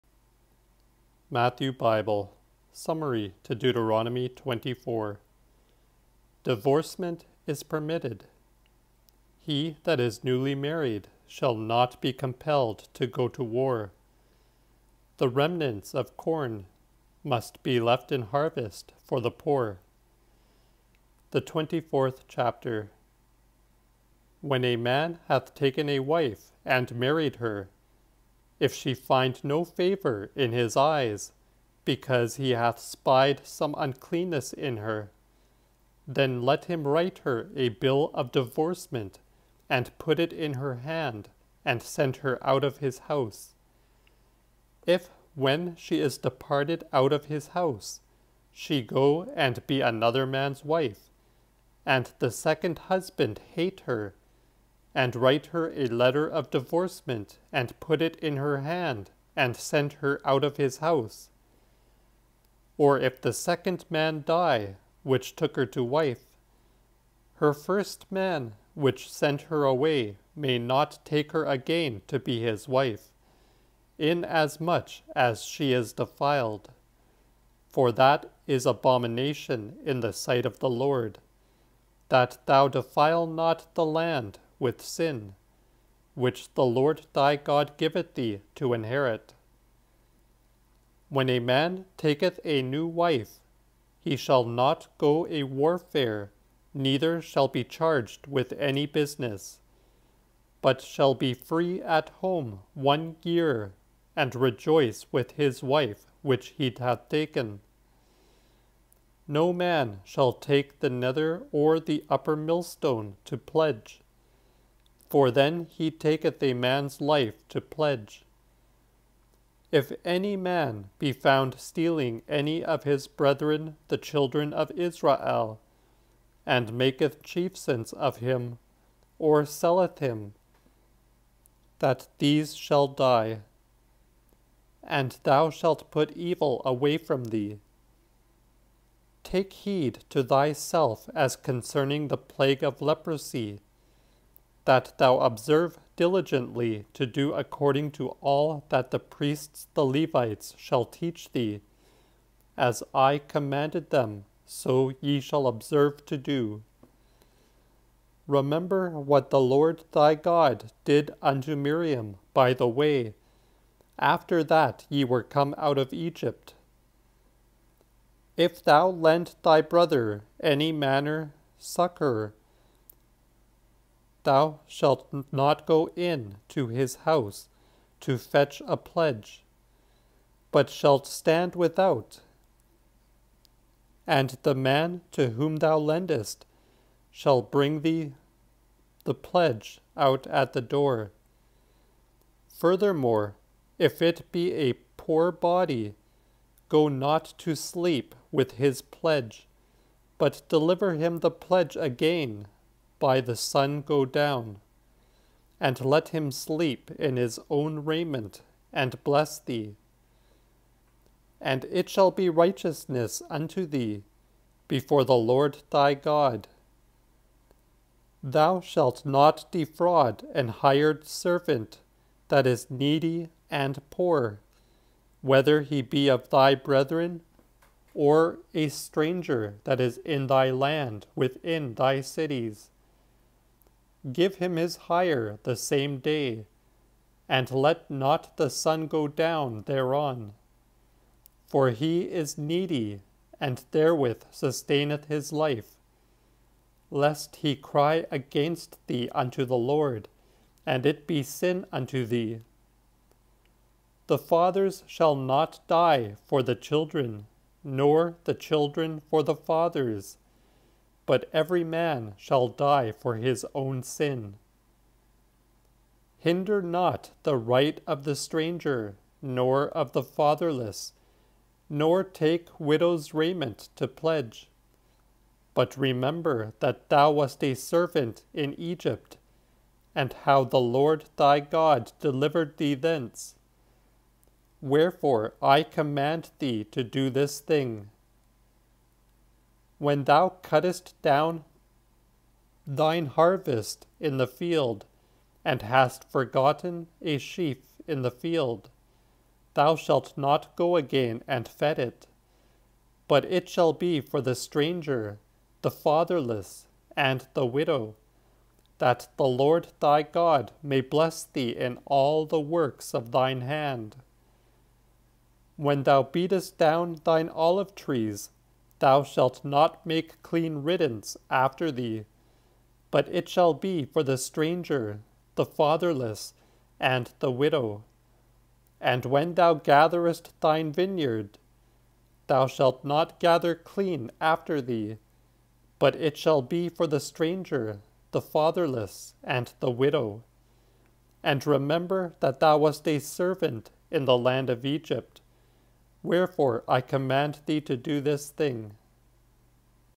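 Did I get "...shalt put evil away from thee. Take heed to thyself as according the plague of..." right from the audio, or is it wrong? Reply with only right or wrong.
wrong.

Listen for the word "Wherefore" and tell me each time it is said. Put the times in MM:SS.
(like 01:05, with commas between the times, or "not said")
04:44, 05:46.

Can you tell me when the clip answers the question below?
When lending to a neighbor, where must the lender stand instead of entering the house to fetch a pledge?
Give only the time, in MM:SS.
03:01.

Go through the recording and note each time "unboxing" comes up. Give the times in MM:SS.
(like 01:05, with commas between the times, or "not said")
not said.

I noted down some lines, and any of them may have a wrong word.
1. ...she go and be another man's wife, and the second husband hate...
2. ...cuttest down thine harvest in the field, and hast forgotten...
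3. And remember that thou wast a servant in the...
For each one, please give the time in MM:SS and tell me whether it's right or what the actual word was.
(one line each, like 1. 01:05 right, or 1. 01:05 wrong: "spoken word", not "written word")
1. 00:48 right
2. 04:50 right
3. 05:41 right.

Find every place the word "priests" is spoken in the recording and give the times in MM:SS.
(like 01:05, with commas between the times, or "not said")
02:28.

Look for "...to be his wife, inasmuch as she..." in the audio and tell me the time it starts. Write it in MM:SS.
01:12.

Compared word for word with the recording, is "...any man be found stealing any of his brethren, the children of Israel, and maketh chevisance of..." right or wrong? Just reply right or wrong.
right.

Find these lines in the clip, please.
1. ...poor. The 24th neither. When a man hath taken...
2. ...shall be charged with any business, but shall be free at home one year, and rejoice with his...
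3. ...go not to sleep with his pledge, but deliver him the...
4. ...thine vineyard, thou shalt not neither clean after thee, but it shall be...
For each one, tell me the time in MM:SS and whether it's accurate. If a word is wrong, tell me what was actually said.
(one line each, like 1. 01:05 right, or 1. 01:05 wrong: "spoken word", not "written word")
1. 00:19 wrong: "chapter", not "neither"
2. 01:37 right
3. 03:16 right
4. 05:30 wrong: "gather", not "neither".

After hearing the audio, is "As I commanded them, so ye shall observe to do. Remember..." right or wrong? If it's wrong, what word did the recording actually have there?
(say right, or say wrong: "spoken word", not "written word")
right.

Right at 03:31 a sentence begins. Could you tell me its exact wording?
And it shall be righteousness unto thee before the Lord thy God.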